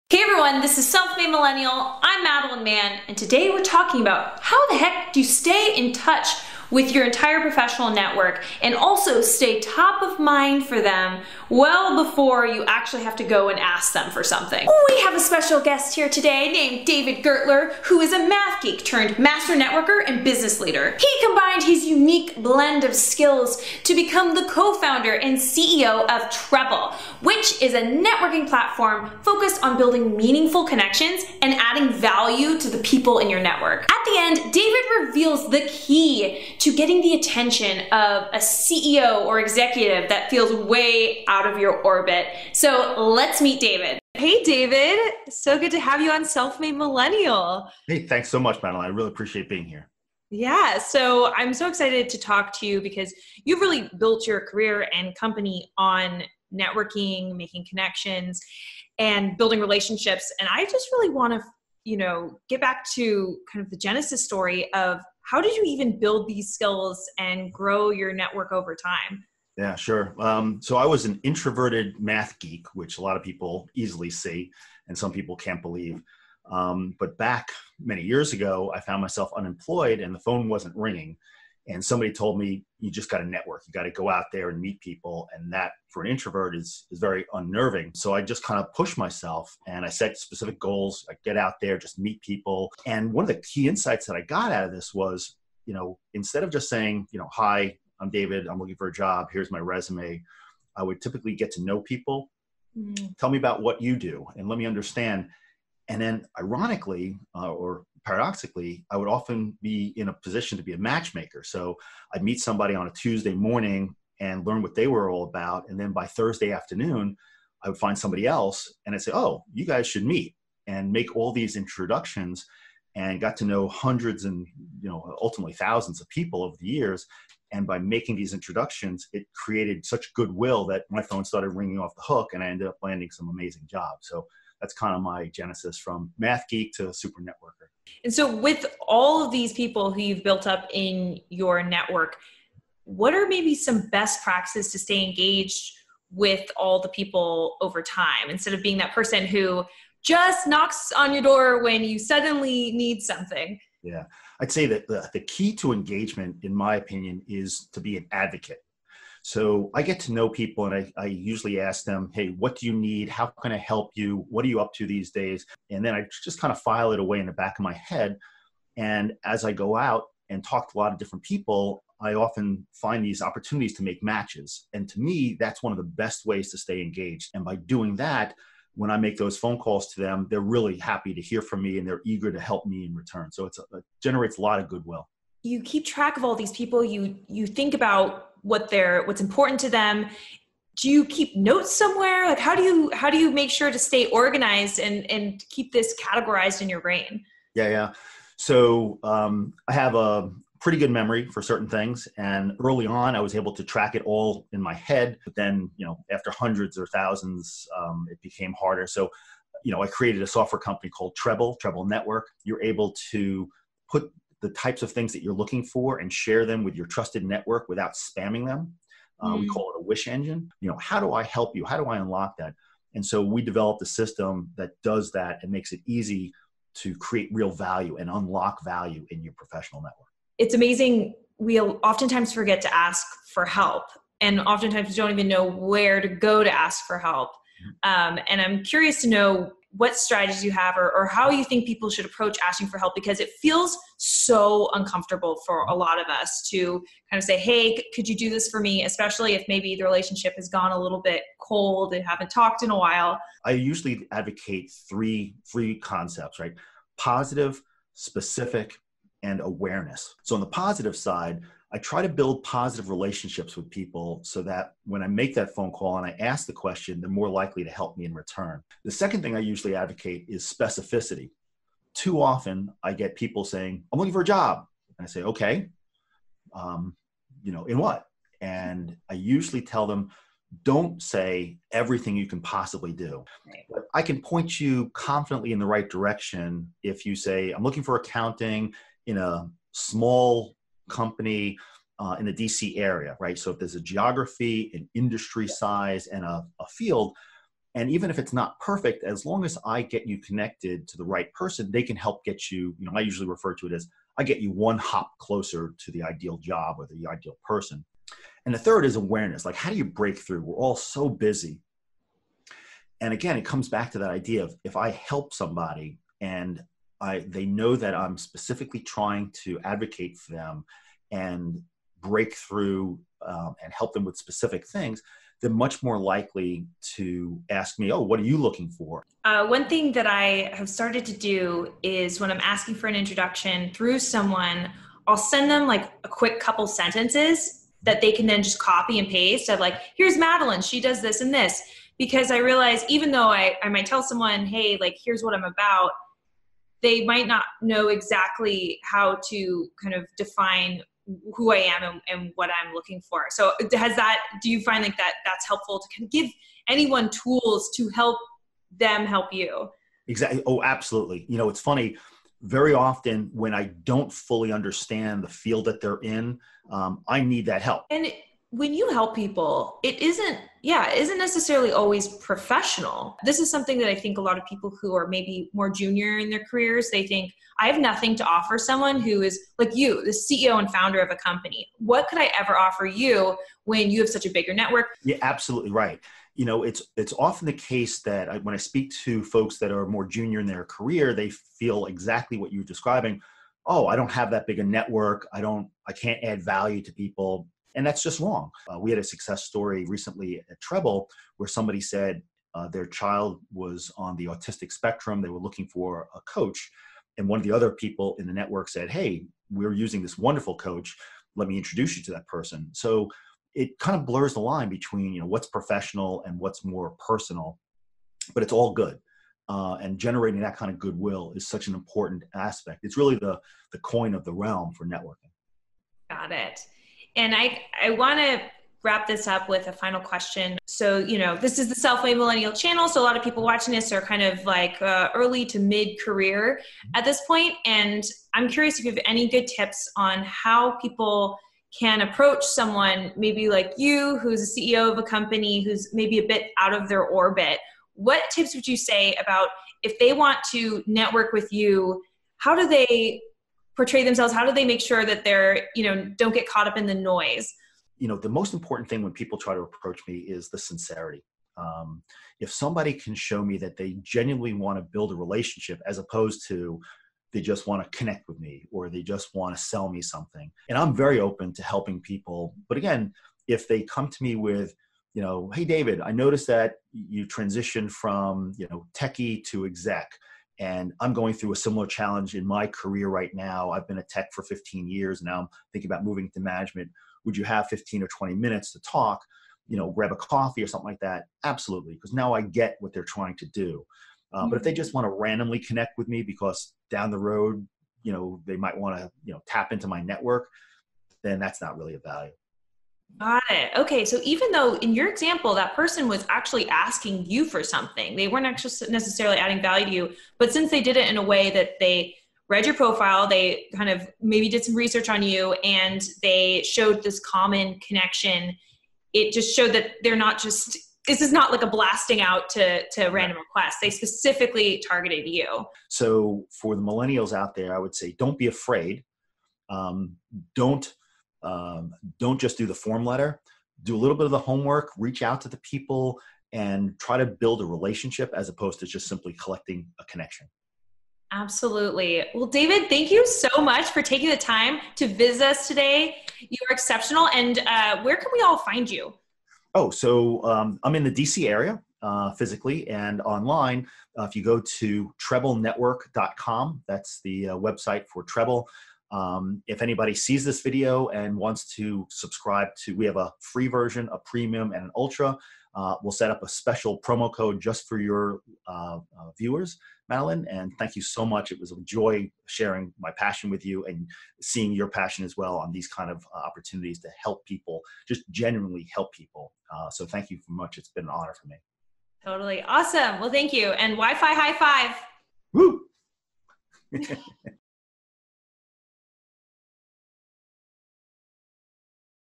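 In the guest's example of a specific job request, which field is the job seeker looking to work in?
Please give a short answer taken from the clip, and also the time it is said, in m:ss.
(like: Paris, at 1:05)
accounting, at 4:47.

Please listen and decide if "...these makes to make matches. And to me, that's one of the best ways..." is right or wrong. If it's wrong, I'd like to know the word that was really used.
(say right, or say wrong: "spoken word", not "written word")
wrong: "opportunities", not "makes".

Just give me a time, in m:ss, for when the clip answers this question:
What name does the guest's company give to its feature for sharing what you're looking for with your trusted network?
3:39.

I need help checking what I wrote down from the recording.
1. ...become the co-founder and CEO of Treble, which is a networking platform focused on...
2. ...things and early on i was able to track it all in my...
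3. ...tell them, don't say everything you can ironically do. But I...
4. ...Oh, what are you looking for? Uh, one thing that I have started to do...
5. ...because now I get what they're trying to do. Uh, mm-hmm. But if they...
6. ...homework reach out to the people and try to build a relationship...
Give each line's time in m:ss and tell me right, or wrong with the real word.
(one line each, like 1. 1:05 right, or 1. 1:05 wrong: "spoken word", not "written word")
1. 0:23 right
2. 3:21 right
3. 4:39 wrong: "possibly", not "ironically"
4. 5:27 right
5. 8:11 right
6. 8:54 right.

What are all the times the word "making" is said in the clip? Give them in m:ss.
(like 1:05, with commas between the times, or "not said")
0:57, 2:07.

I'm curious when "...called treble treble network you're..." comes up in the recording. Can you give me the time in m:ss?
3:30.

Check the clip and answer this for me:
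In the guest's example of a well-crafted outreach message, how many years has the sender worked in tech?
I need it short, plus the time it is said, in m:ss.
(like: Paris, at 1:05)
15, at 8:04.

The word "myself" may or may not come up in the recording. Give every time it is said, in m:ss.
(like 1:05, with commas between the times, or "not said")
1:19, 1:28.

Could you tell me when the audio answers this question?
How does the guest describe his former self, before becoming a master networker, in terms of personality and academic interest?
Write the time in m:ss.
1:11.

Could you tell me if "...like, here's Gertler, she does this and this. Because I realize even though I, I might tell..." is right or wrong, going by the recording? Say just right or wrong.
wrong.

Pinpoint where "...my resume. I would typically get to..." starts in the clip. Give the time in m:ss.
1:39.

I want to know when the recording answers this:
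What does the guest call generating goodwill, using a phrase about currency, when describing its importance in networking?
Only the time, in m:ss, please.
7:03.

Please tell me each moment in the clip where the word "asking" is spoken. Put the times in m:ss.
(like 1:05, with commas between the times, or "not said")
4:02, 5:32, 8:26.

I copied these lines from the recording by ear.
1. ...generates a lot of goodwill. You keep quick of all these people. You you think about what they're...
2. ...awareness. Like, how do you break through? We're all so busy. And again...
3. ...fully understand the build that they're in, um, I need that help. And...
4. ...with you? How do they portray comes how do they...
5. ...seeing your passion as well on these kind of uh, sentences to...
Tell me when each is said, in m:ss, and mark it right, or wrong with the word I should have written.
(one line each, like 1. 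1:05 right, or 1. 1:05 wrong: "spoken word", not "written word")
1. 3:04 wrong: "track", not "quick"
2. 5:08 right
3. 6:04 wrong: "field", not "build"
4. 7:31 wrong: "themselves", not "comes"
5. 9:34 wrong: "opportunities", not "sentences".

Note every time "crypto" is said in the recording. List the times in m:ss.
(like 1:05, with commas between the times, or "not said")
not said.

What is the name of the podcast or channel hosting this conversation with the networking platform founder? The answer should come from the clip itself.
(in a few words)
Self-Made Millennial.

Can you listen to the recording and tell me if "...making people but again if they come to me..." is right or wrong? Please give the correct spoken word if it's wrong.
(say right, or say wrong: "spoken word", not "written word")
wrong: "helping", not "making".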